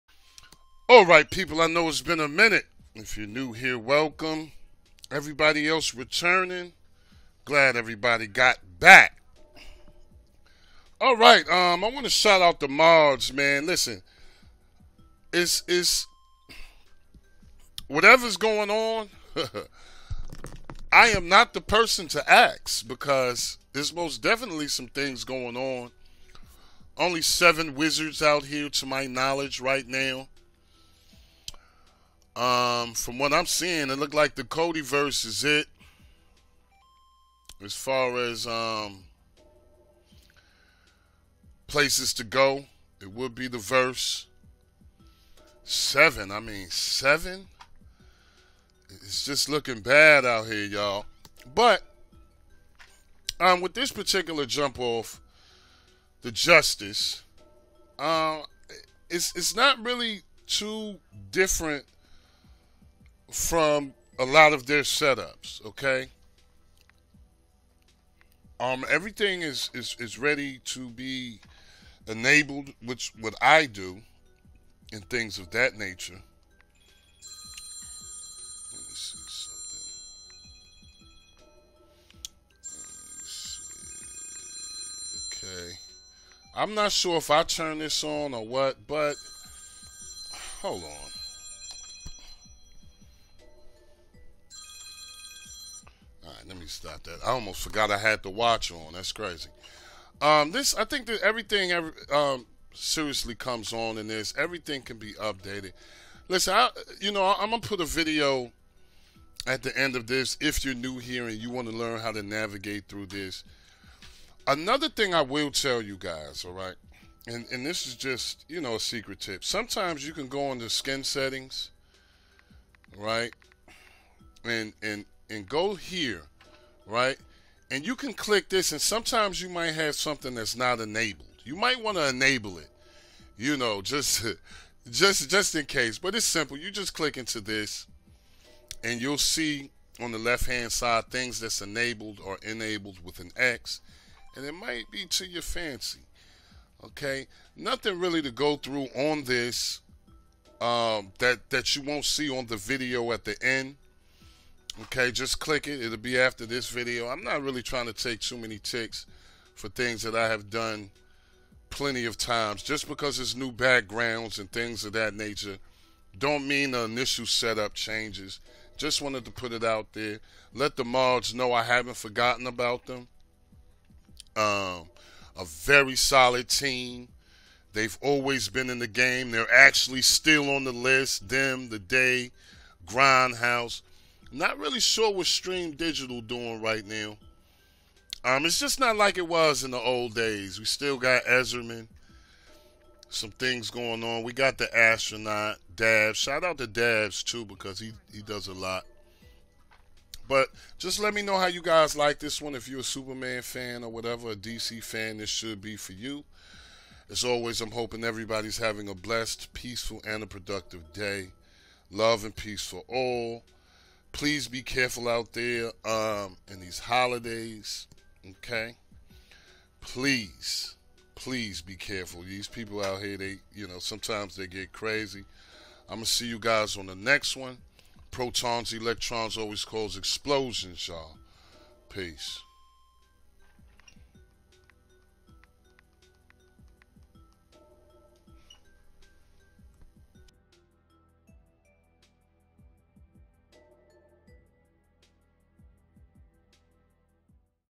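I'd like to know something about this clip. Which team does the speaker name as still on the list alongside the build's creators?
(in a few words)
Grindhouse.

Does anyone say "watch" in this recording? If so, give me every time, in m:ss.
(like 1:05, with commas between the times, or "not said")
1:38.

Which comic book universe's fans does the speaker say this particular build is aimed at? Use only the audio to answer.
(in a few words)
DC.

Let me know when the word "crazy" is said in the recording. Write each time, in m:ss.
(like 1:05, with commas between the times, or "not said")
1:39, 3:44.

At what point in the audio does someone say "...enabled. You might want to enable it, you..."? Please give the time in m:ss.
2:10.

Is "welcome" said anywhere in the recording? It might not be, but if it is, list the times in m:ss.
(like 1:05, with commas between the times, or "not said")
0:03.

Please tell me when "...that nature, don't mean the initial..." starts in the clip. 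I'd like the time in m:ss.
2:44.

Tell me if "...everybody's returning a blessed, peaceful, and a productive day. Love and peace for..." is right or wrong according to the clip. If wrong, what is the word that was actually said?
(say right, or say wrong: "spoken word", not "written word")
wrong: "having", not "returning".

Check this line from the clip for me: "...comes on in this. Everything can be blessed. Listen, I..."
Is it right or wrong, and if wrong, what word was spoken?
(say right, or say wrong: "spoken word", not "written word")
wrong: "updated", not "blessed".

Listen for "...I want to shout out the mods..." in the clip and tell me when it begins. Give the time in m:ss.
0:11.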